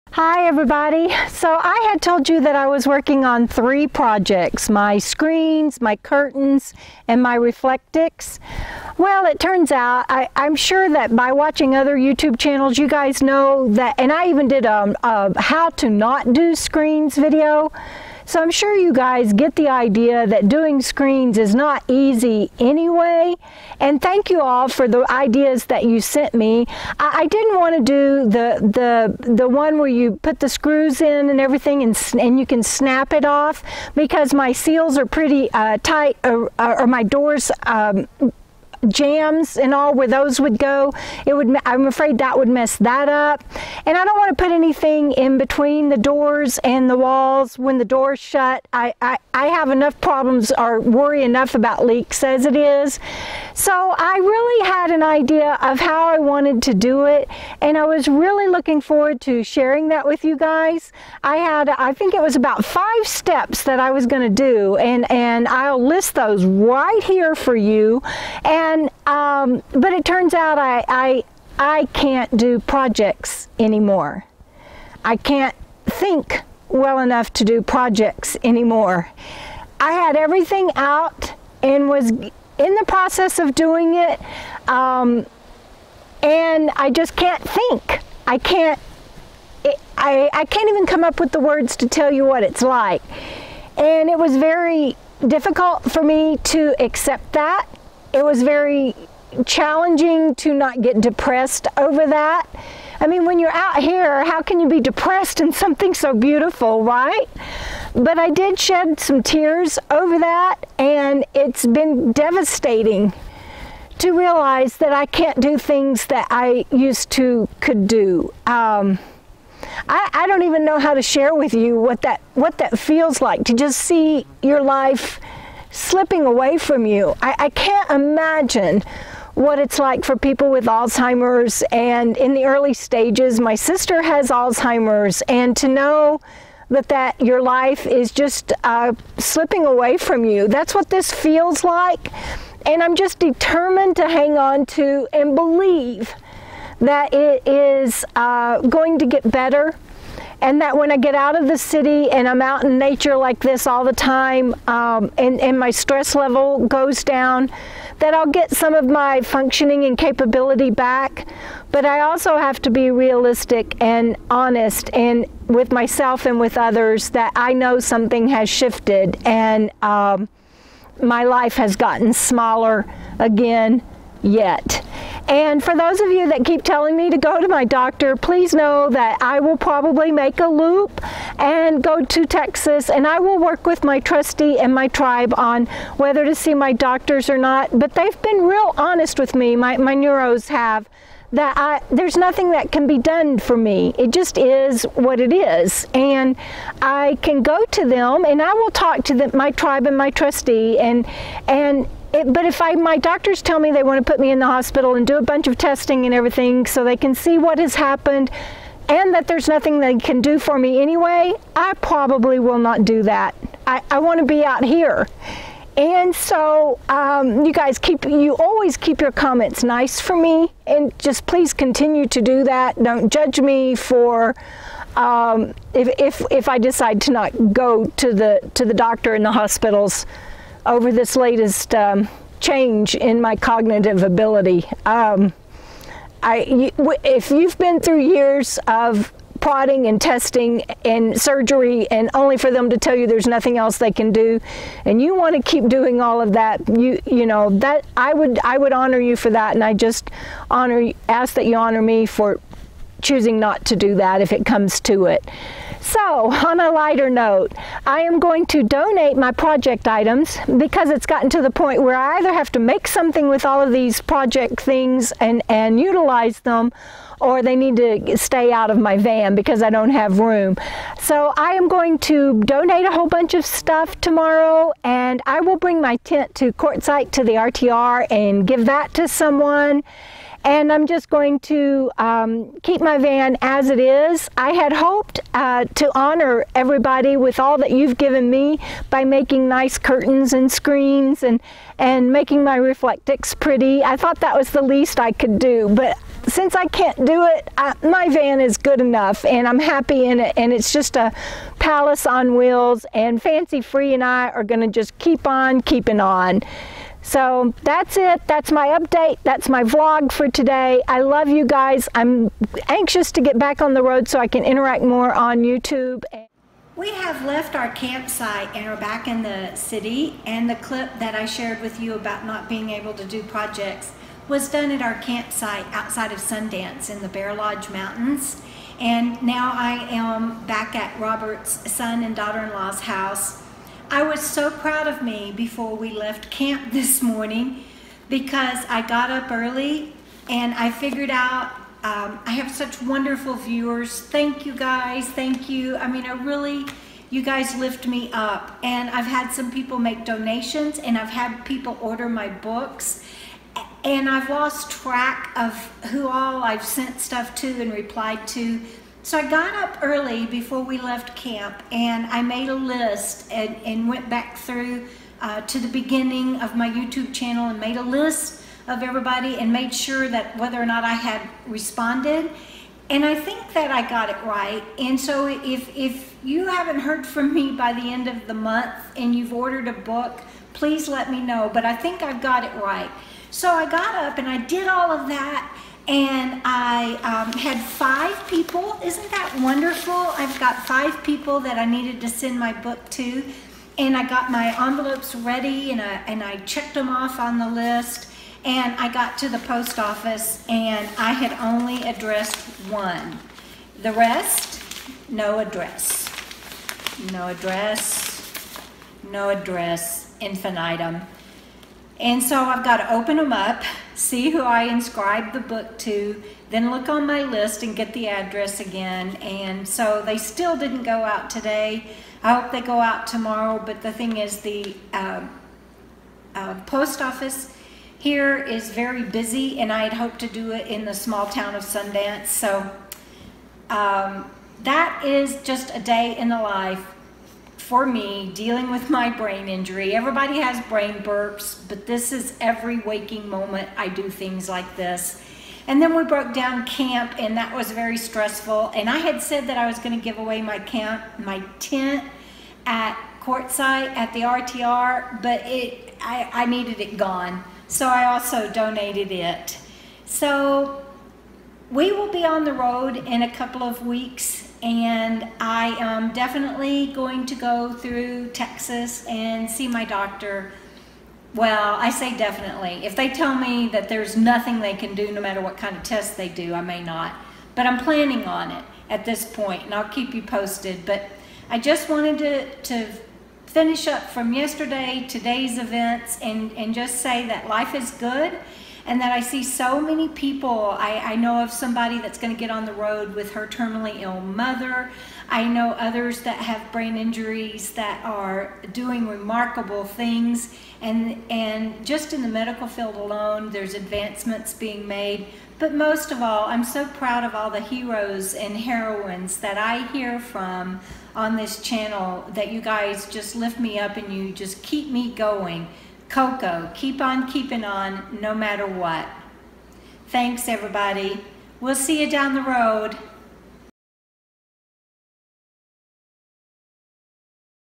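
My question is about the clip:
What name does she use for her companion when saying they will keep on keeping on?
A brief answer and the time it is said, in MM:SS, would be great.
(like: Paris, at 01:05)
Fancy Free, at 05:03.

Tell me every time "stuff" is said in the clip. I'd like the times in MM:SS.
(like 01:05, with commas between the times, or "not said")
04:33, 05:57.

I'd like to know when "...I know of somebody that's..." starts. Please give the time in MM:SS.
08:11.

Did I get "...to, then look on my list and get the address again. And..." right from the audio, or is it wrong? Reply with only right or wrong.
right.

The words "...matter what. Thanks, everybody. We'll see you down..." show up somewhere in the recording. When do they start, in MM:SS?
08:38.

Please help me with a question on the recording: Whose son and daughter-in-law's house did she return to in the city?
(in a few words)
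Robert's.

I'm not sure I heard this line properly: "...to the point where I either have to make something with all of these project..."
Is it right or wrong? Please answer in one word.
right.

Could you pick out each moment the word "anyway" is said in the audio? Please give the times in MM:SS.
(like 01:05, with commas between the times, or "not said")
00:22, 03:30.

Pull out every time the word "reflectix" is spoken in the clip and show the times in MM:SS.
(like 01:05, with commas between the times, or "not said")
00:07, 04:52.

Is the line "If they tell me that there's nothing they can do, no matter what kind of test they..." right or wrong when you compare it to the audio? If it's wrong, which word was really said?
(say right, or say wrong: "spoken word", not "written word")
right.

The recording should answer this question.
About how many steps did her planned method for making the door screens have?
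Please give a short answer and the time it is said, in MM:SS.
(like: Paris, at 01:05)
5, at 01:02.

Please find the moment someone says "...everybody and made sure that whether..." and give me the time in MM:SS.
06:08.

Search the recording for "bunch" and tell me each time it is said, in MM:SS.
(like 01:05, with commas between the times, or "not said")
03:25, 04:33.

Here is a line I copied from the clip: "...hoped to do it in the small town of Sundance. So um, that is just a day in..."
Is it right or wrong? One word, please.
right.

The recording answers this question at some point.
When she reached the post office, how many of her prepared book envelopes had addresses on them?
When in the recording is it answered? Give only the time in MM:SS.
06:41.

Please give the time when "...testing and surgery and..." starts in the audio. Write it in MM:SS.
03:59.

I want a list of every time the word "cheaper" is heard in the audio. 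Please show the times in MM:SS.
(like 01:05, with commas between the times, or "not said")
not said.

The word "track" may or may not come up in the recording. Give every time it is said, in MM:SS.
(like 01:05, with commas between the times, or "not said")
05:54.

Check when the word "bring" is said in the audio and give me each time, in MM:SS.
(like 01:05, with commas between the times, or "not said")
04:35.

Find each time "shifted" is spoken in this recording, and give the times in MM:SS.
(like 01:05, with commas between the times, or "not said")
02:48.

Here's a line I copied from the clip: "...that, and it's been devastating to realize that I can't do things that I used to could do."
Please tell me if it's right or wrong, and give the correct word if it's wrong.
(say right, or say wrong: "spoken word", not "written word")
right.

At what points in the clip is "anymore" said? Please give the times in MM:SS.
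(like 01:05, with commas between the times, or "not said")
01:13, 01:18.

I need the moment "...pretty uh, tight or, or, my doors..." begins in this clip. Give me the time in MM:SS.
00:35.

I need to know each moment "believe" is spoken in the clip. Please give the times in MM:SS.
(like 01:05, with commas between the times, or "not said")
02:25.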